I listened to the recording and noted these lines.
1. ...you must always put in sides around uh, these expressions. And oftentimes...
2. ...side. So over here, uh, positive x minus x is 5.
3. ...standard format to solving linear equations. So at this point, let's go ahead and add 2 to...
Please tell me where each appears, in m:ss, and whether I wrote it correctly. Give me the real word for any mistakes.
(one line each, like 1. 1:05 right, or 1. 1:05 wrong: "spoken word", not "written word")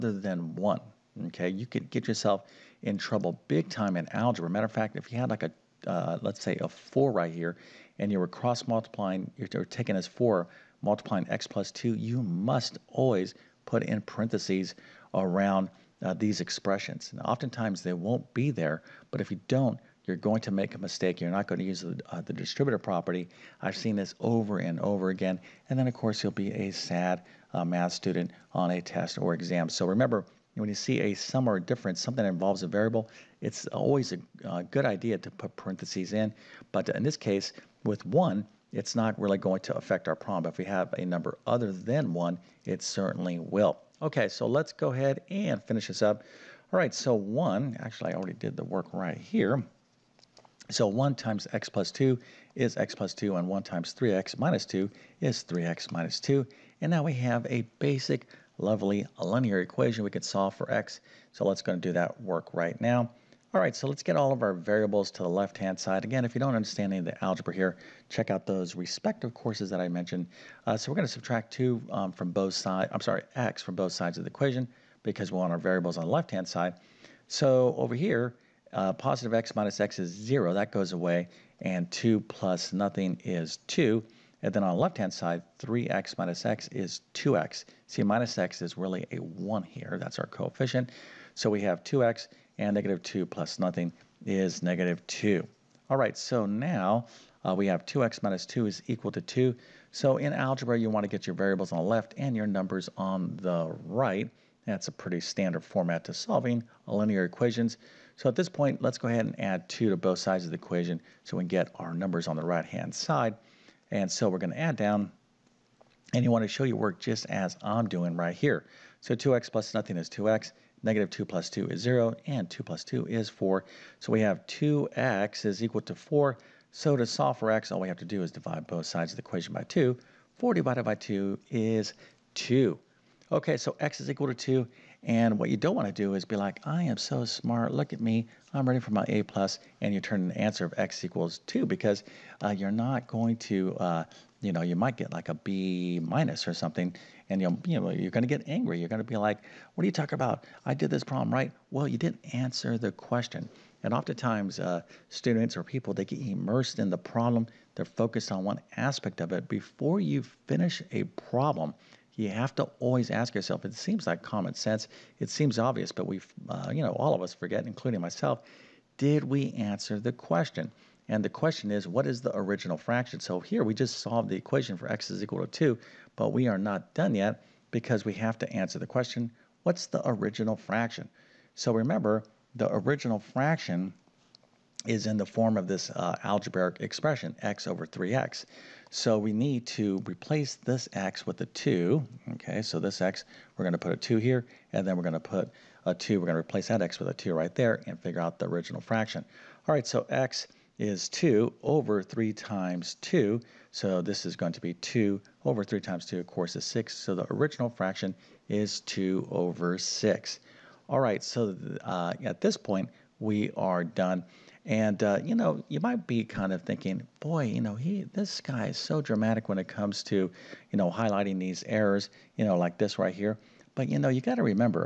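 1. 0:11 wrong: "parentheses", not "sides"
2. 1:16 wrong: "0", not "5"
3. 1:45 right.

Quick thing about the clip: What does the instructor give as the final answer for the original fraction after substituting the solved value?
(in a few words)
2/6.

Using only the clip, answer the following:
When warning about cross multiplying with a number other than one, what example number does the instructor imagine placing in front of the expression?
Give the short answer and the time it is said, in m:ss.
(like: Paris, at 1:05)
4, at 0:06.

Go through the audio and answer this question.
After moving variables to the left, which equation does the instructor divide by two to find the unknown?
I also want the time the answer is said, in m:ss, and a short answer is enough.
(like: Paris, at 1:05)
2x = 4, at 2:04.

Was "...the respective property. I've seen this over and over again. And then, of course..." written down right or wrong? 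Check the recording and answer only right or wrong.
wrong.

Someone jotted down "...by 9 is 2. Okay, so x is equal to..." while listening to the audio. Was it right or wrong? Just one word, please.
wrong.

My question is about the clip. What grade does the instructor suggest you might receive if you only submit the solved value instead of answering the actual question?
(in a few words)
B minus.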